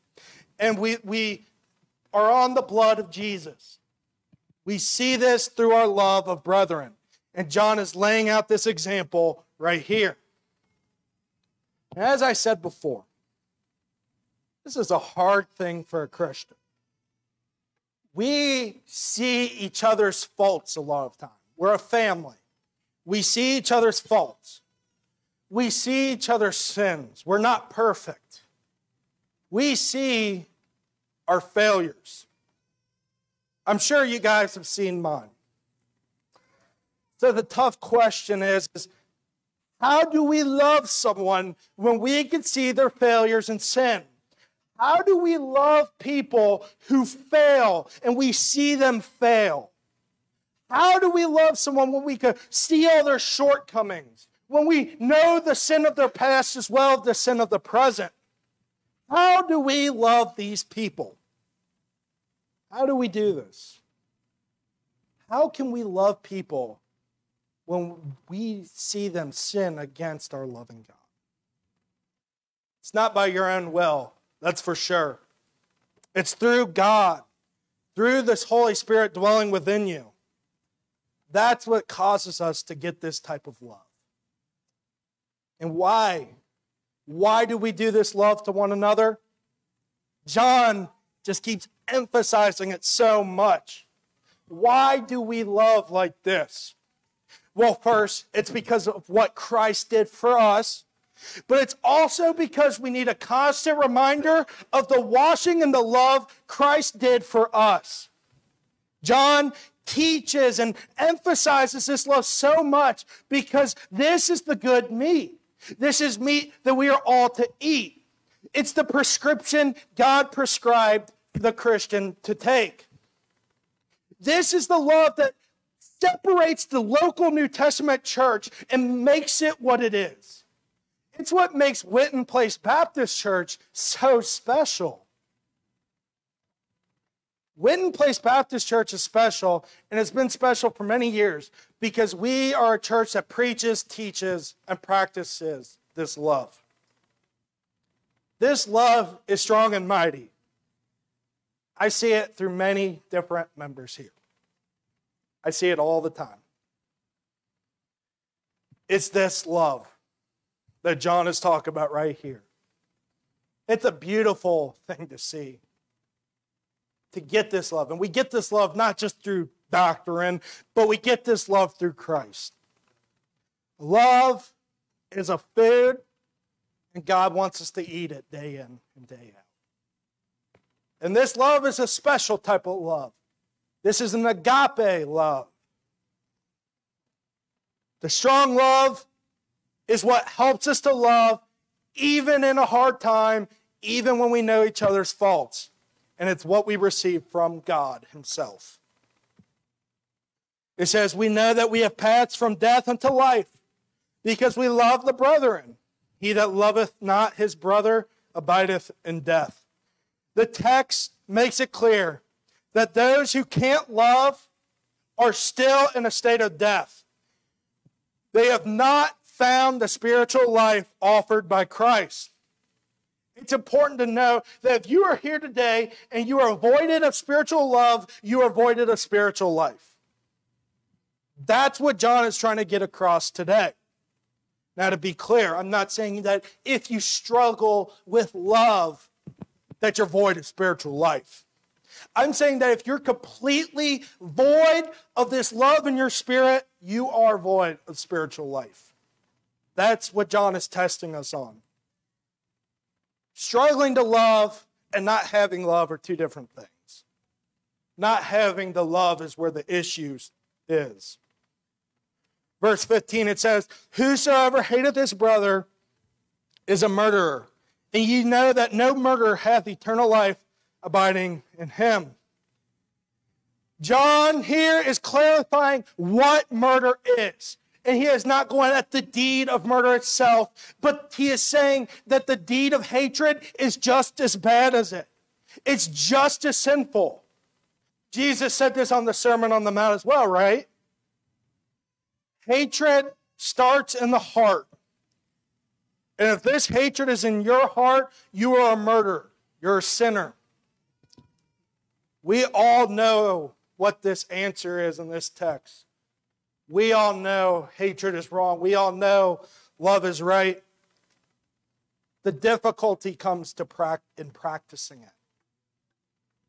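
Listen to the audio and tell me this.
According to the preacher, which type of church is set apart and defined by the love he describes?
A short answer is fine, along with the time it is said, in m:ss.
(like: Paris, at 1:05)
local New Testament church, at 2:06.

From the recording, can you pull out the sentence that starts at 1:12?
It's not by your own will, that's for sure.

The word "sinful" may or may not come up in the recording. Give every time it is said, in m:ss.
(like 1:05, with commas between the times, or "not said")
4:46.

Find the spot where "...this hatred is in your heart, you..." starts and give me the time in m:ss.
4:56.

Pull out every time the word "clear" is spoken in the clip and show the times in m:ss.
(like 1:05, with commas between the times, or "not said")
3:31, 3:55.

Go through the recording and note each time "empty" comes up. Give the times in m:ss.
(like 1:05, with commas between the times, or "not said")
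not said.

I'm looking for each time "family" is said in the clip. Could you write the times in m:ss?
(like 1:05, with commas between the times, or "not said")
0:21.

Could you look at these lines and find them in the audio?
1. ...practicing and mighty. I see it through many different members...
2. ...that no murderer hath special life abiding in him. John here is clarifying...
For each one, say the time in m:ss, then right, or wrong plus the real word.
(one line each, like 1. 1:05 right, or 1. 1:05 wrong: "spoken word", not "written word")
1. 2:29 wrong: "strong", not "practicing"
2. 4:28 wrong: "eternal", not "special".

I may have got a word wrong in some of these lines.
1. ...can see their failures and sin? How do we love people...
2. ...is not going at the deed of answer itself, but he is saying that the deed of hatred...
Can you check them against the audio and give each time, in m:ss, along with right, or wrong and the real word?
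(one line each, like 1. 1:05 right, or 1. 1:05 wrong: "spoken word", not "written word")
1. 0:42 right
2. 4:38 wrong: "murder", not "answer".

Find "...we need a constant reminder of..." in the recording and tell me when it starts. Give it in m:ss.
1:42.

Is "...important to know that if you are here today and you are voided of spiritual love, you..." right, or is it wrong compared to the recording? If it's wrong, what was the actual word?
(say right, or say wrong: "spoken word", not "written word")
right.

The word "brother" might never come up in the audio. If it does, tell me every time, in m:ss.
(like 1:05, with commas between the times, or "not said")
3:27, 4:25.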